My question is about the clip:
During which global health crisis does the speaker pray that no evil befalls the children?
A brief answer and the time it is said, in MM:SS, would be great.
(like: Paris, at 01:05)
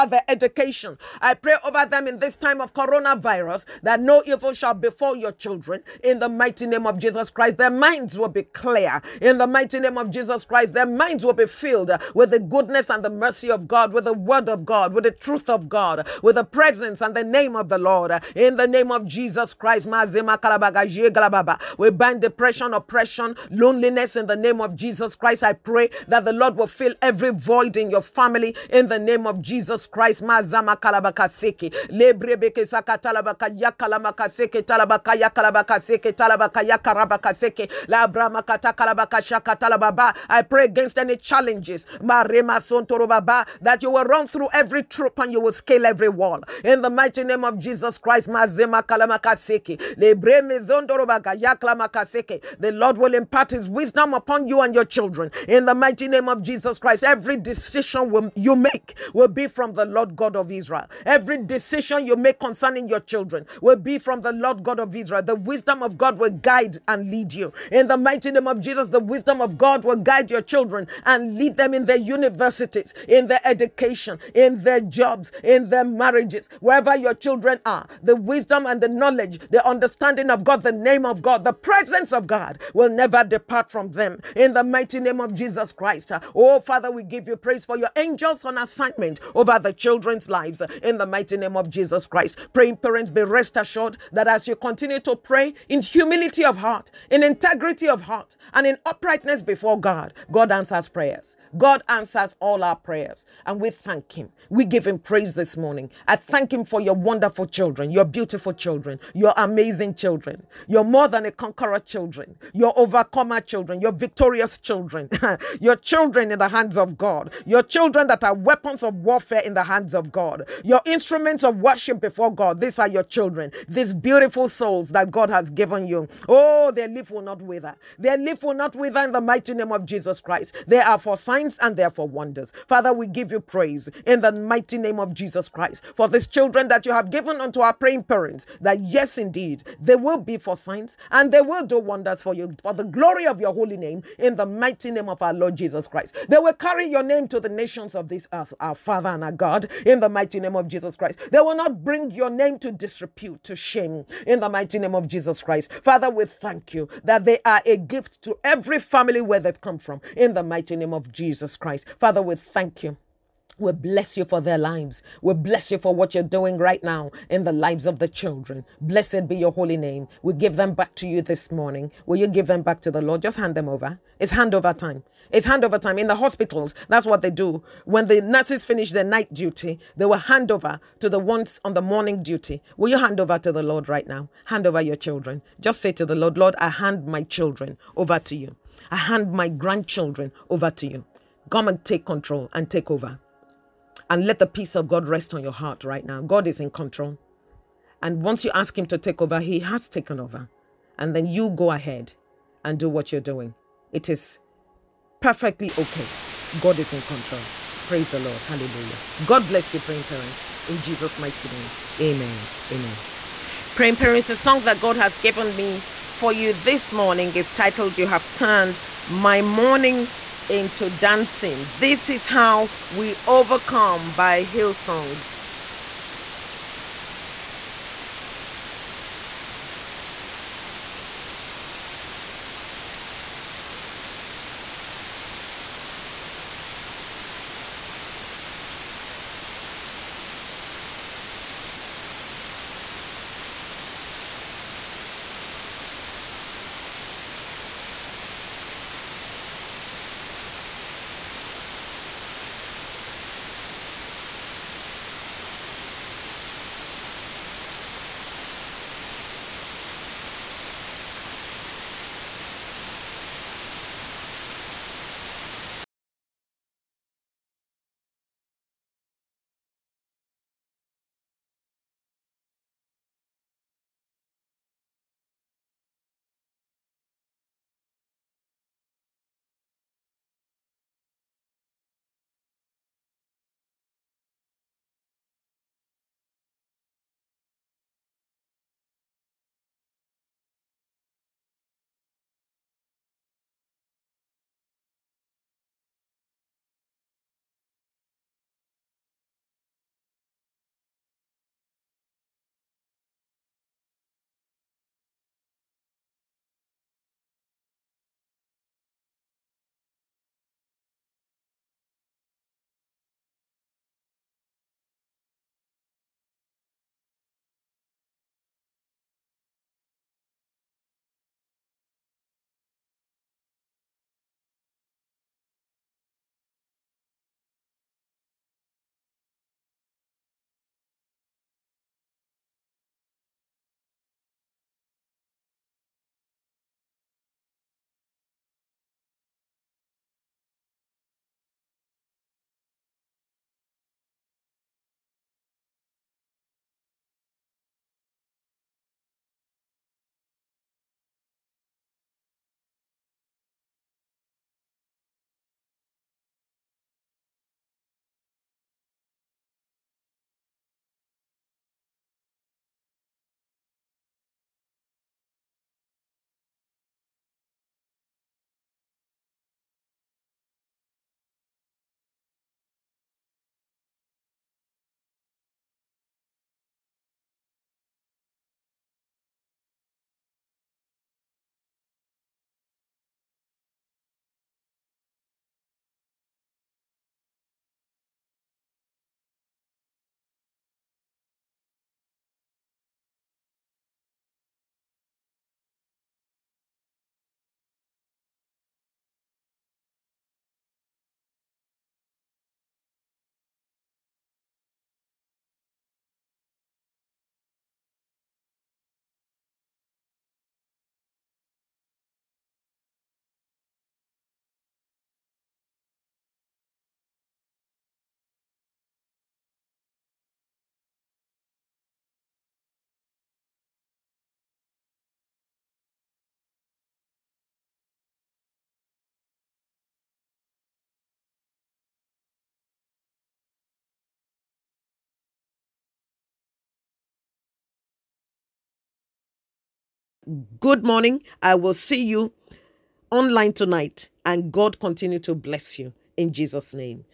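coronavirus, at 00:02.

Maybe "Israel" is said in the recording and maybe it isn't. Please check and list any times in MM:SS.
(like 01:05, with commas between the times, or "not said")
01:00, 01:04.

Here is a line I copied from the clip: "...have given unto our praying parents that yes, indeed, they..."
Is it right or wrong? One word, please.
right.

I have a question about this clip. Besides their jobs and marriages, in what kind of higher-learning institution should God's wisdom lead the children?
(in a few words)
universities.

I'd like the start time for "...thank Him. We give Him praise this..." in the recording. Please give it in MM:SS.
01:43.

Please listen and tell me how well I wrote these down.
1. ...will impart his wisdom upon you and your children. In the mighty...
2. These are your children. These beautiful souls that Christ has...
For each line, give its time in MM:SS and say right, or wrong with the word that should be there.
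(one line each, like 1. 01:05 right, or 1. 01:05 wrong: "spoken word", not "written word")
1. 00:52 right
2. 02:02 wrong: "God", not "Christ".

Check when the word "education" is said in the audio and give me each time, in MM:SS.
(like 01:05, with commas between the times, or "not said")
00:00, 01:13.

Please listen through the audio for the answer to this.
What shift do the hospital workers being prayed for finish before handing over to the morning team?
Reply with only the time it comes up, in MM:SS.
02:59.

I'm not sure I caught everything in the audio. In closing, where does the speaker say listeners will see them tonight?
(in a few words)
online.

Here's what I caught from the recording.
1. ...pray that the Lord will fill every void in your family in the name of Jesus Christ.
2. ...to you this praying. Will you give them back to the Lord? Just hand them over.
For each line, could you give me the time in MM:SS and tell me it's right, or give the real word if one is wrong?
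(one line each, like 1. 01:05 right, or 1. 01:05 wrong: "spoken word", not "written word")
1. 00:25 right
2. 02:50 wrong: "morning", not "praying".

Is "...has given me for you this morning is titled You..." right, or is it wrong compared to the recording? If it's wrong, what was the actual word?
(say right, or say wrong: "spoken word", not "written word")
right.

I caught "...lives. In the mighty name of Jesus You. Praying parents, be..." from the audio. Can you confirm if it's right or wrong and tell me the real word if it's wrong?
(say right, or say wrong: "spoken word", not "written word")
wrong: "Christ", not "You".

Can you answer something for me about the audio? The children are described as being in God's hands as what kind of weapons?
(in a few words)
weapons of warfare.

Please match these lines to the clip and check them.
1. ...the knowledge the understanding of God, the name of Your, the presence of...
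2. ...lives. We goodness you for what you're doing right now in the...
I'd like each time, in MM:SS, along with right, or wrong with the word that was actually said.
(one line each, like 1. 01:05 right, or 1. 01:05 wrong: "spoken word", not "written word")
1. 01:18 wrong: "God", not "Your"
2. 02:44 wrong: "bless", not "goodness".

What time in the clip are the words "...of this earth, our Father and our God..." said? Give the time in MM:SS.
02:27.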